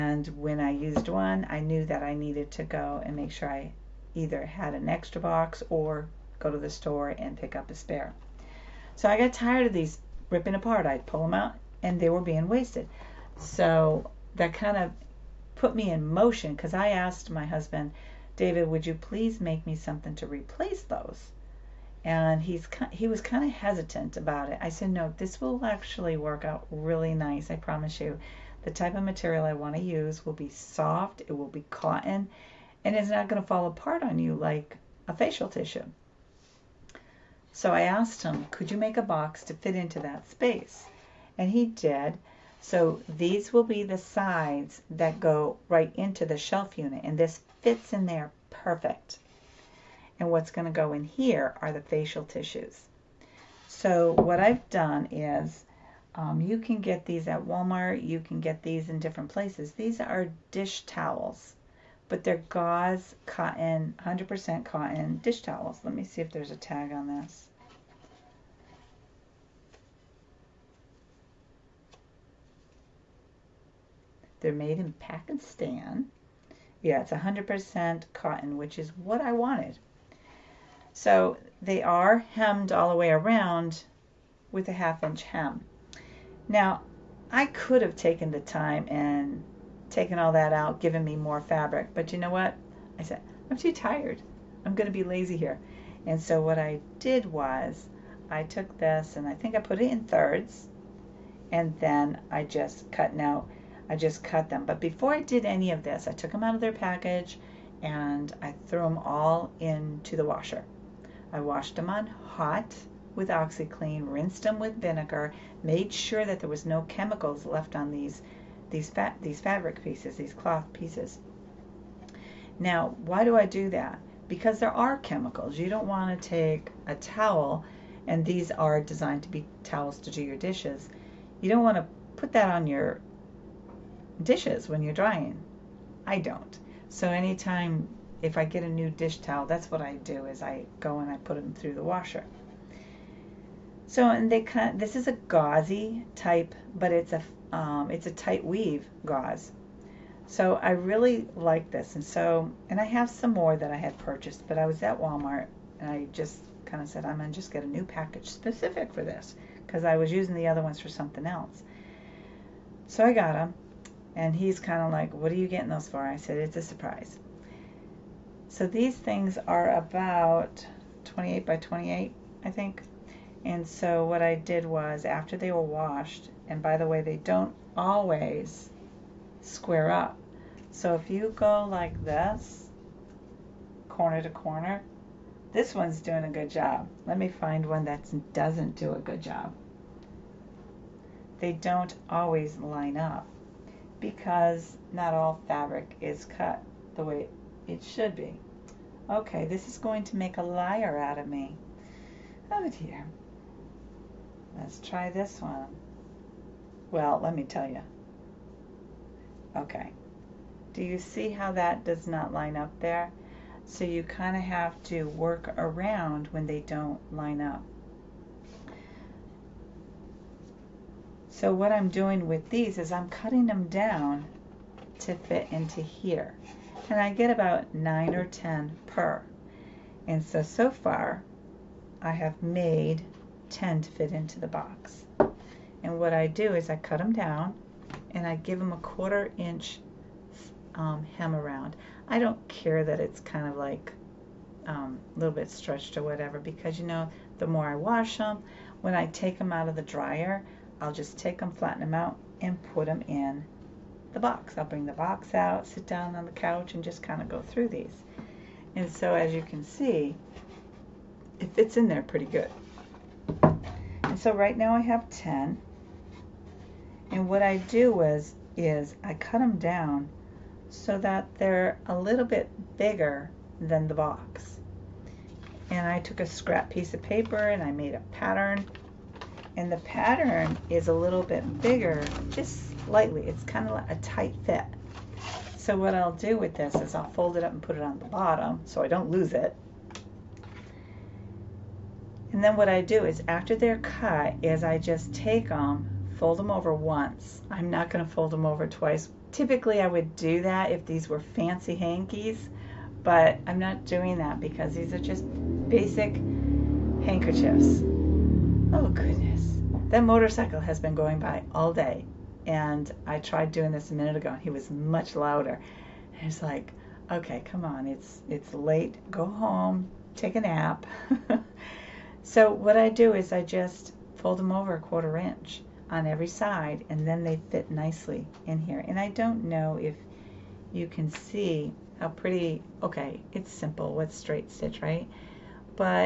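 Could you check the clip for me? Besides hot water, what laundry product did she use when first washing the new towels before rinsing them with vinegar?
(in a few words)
OxiClean.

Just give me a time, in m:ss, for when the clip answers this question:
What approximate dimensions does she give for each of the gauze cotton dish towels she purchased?
2:51.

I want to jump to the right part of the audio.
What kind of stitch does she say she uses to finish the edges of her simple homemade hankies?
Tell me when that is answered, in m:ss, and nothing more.
5:34.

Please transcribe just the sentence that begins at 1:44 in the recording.
But before I did any of this, I took them out of their package and I threw them all into the washer.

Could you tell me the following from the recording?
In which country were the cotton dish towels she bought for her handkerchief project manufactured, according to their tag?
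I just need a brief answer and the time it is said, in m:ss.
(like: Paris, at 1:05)
Pakistan, at 1:14.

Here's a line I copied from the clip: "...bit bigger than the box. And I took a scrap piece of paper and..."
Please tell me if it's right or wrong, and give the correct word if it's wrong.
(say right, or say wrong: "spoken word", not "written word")
right.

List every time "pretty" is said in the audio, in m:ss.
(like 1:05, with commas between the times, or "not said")
4:22, 5:32.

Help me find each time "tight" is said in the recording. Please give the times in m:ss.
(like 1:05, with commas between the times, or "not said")
2:28, 4:43.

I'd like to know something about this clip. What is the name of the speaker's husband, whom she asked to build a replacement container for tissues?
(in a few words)
David.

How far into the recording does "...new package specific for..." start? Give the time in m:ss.
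2:37.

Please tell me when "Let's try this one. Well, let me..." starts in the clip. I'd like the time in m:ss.
3:24.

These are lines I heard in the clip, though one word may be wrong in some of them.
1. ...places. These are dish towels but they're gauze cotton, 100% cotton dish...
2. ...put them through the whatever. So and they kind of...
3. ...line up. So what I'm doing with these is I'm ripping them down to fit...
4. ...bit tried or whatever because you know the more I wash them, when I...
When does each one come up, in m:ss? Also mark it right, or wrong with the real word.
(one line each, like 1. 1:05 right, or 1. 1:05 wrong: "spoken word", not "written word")
1. 0:59 right
2. 2:21 wrong: "washer", not "whatever"
3. 3:37 wrong: "cutting", not "ripping"
4. 4:05 wrong: "stretched", not "tried".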